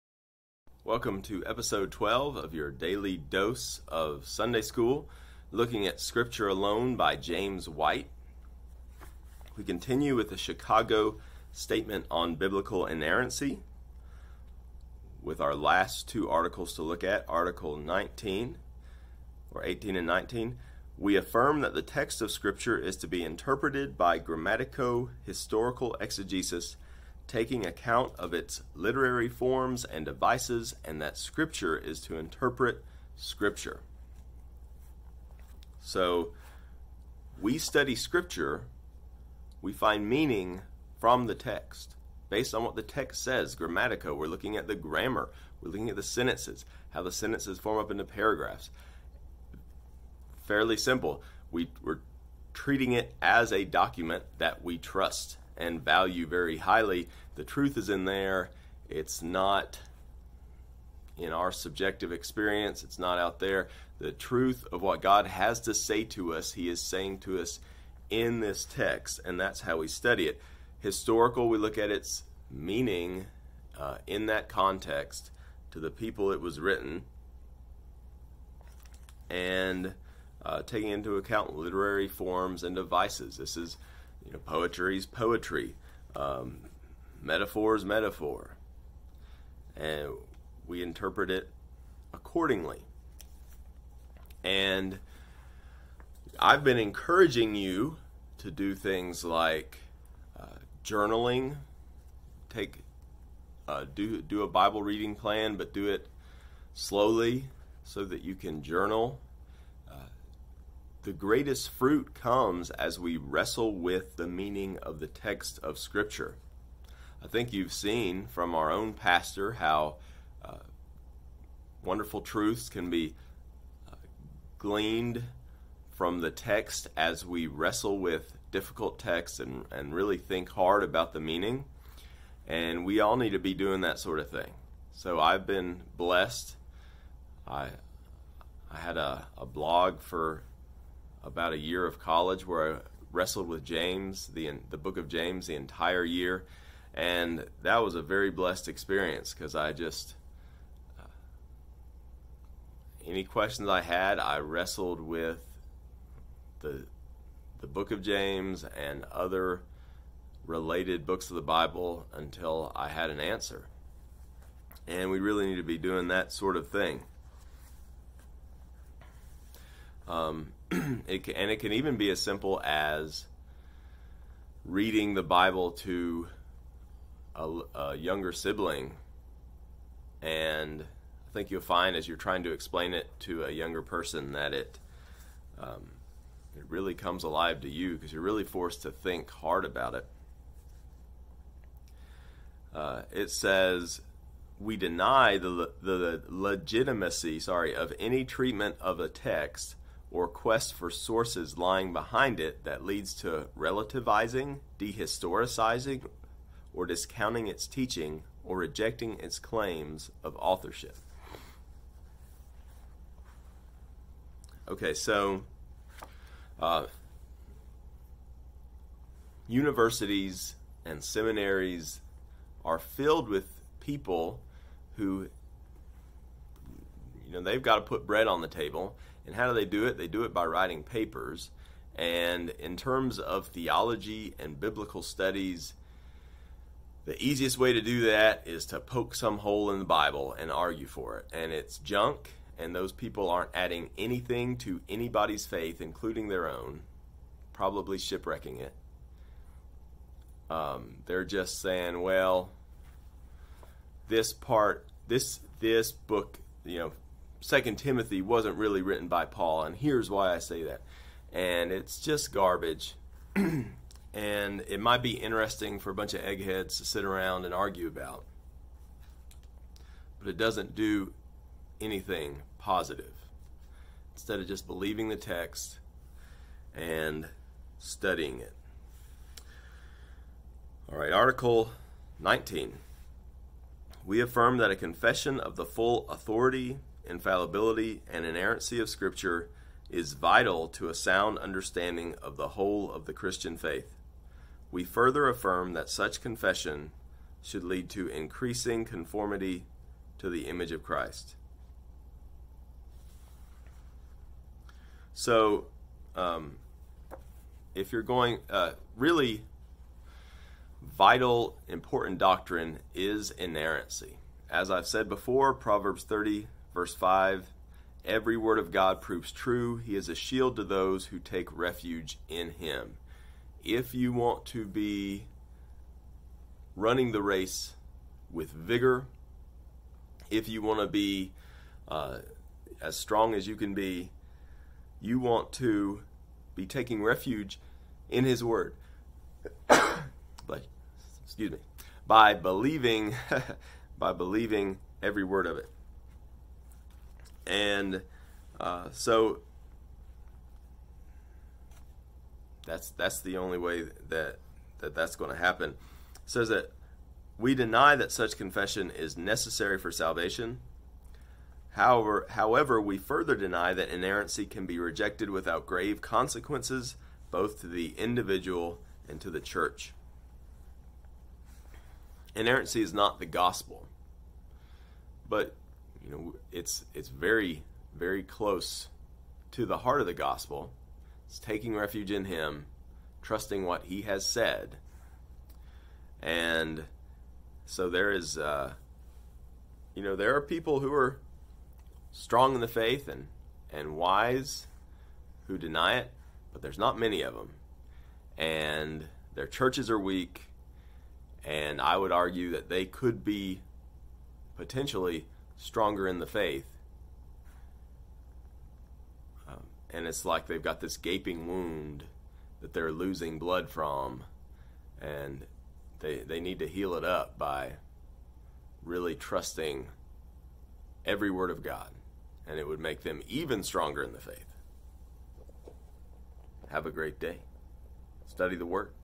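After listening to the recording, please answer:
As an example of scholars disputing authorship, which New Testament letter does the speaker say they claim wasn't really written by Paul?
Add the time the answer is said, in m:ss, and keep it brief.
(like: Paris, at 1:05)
Second Timothy, at 4:17.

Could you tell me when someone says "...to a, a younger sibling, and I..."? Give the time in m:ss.
2:55.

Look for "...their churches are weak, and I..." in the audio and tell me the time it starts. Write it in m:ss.
6:39.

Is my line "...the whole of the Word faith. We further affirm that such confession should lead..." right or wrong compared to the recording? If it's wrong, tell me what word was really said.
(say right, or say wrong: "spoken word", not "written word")
wrong: "Christian", not "Word".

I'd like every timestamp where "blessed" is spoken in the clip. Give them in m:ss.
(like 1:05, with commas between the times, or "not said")
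2:15, 2:28.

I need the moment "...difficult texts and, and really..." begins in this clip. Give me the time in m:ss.
2:08.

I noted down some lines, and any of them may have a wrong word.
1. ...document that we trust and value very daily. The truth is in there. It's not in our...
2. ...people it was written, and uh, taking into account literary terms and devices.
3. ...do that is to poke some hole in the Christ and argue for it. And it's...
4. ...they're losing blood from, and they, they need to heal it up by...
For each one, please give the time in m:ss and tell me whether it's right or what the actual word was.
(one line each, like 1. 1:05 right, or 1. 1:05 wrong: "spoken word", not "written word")
1. 0:53 wrong: "highly", not "daily"
2. 1:15 wrong: "forms", not "terms"
3. 3:57 wrong: "Bible", not "Christ"
4. 6:52 right.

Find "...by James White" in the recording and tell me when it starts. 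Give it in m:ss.
0:06.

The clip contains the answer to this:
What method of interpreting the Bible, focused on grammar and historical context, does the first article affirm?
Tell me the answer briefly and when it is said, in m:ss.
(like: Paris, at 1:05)
grammatico historical exegesis, at 0:24.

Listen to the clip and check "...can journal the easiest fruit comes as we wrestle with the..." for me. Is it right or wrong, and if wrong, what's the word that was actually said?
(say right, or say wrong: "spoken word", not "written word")
wrong: "greatest", not "easiest".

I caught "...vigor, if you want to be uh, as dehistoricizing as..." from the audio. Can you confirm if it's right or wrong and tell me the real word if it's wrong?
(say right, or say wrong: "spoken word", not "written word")
wrong: "strong", not "dehistoricizing".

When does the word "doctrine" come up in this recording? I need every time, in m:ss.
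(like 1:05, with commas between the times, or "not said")
5:12.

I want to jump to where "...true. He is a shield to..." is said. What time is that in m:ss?
5:19.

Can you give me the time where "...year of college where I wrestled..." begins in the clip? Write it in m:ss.
2:21.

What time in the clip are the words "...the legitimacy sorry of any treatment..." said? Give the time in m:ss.
3:15.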